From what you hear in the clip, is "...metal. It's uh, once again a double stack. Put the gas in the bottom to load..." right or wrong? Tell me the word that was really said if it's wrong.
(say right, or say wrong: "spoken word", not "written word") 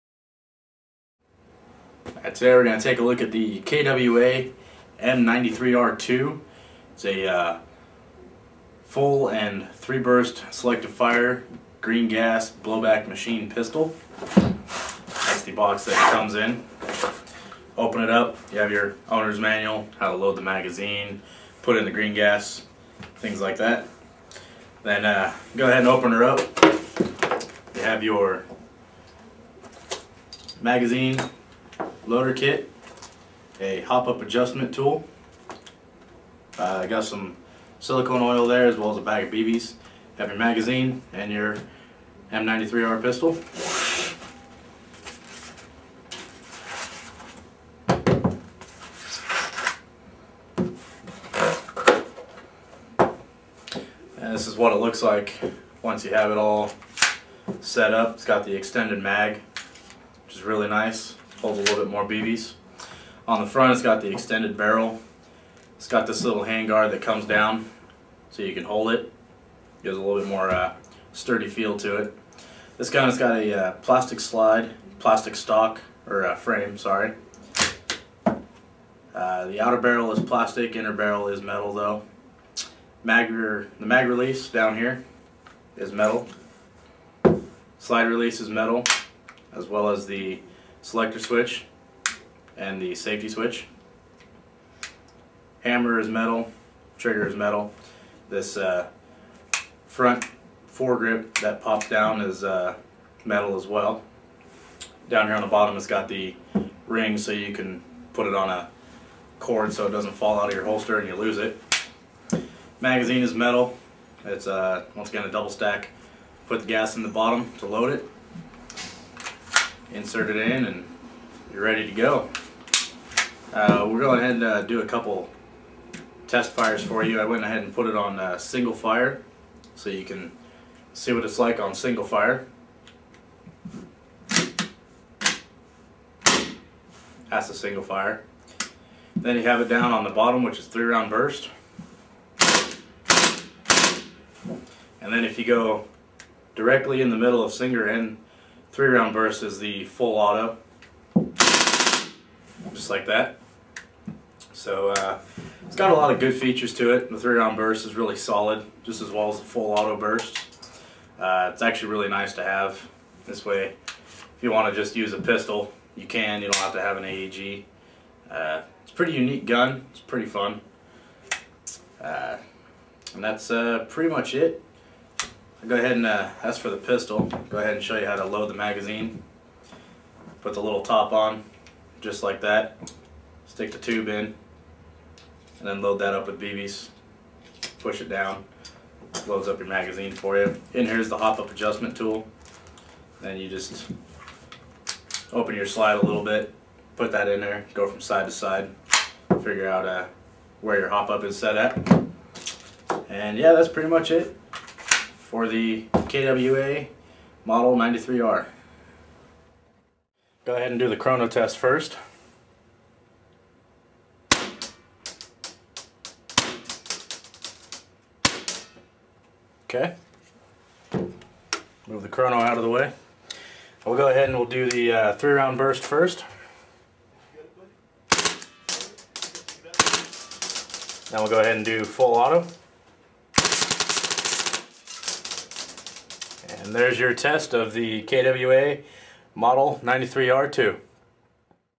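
right.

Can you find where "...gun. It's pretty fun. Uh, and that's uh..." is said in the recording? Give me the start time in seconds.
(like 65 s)
169 s.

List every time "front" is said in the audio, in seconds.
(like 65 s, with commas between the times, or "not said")
63 s, 99 s.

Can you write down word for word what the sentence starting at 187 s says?
Push it down, loads up your magazine for you.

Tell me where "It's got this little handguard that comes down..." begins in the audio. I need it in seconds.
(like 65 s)
65 s.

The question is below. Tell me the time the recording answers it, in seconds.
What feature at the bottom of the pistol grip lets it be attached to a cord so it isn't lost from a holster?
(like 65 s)
106 s.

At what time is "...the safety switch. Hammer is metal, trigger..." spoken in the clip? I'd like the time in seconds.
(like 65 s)
92 s.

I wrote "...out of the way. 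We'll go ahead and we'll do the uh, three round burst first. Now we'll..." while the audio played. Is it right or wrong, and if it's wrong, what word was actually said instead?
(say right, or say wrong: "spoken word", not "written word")
right.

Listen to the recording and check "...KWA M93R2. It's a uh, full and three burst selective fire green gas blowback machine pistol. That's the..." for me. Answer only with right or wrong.
right.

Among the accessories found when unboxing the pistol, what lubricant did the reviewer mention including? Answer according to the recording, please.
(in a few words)
Silicone oil.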